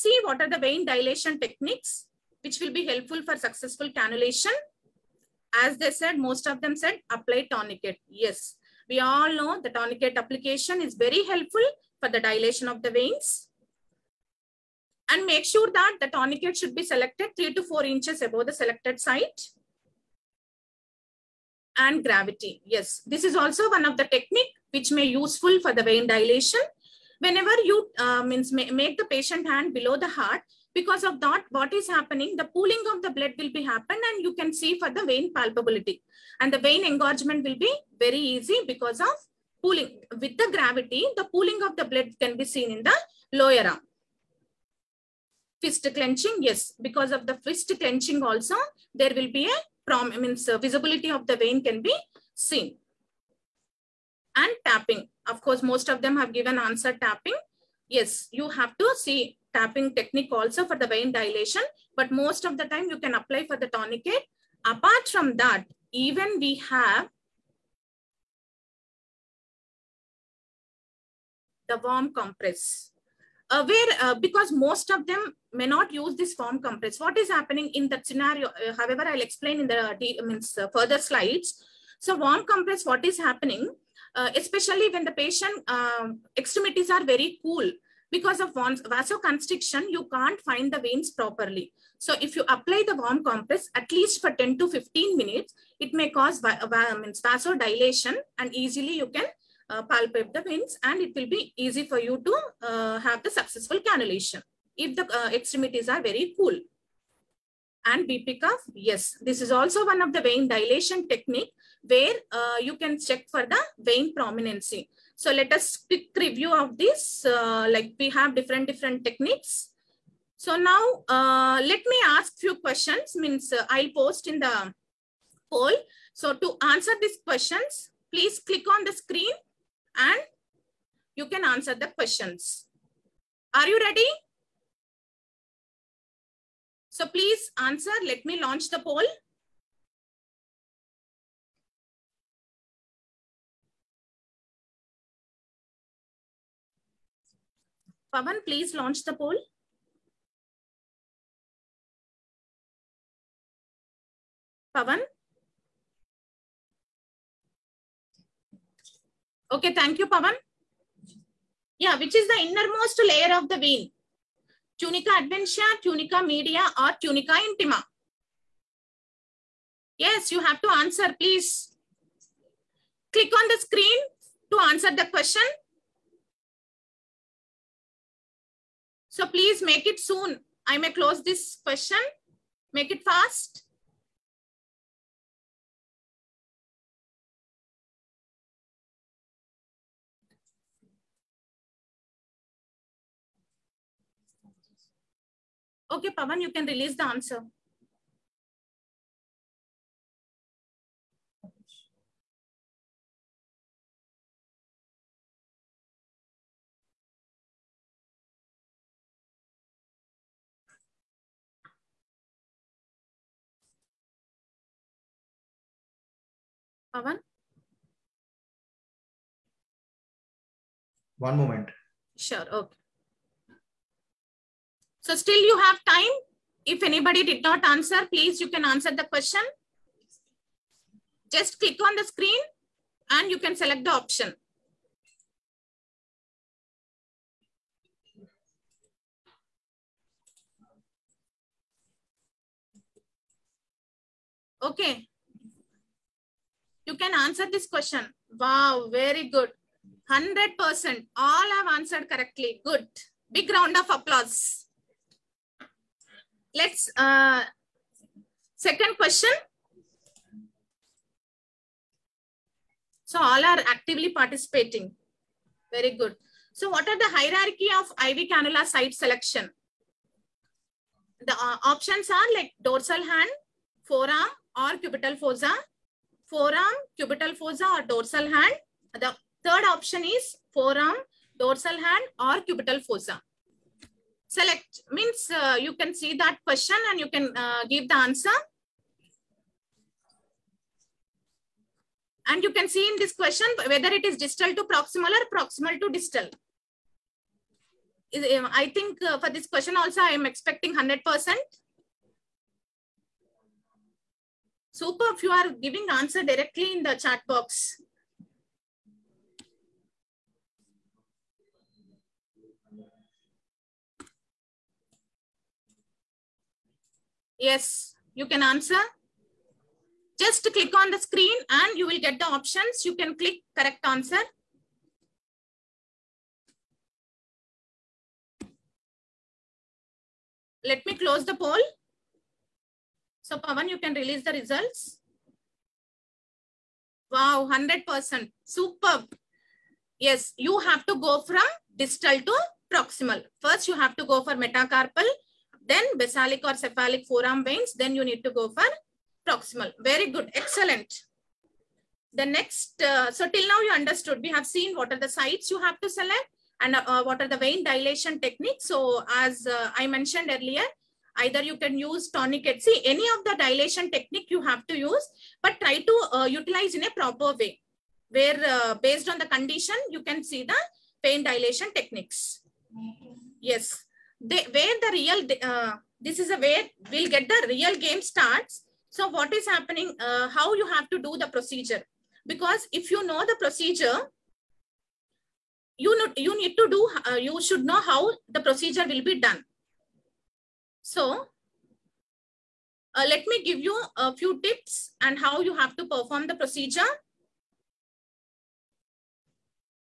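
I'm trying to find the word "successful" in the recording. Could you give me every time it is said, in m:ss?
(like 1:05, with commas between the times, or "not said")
0:03, 1:43.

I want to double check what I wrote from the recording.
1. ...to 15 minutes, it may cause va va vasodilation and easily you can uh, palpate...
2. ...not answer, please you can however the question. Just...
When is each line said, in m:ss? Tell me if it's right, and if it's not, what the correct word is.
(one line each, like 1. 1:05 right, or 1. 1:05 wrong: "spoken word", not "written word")
1. 1:34 right
2. 3:47 wrong: "answer", not "however".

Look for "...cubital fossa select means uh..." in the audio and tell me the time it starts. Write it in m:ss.
4:42.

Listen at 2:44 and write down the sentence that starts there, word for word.
Tunica adventitia, tunica media, or tunica intima?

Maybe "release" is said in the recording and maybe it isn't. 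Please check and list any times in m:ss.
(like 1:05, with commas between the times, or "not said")
3:16, 5:33.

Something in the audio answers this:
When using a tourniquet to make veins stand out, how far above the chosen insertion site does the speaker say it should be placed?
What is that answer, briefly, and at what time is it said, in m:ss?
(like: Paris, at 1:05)
3 to 4 inches, at 0:17.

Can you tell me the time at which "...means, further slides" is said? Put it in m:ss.
1:20.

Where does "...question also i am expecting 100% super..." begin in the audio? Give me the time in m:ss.
4:59.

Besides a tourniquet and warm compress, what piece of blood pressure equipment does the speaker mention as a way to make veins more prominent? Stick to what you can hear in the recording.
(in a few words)
BP cuff.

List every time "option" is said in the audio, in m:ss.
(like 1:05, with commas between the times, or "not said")
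3:53, 4:31, 4:39, 5:22.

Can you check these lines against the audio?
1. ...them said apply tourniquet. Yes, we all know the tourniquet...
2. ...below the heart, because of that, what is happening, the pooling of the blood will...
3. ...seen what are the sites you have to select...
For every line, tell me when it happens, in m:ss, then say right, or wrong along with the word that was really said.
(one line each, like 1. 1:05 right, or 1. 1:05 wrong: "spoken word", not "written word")
1. 0:06 right
2. 0:29 right
3. 5:54 right.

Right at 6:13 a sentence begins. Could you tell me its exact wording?
Yes they, where the real, uh, this is a way we'll get the real game starts.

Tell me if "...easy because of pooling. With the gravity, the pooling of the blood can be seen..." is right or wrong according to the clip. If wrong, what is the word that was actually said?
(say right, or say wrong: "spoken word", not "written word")
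right.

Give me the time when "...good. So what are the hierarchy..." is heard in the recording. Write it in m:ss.
4:25.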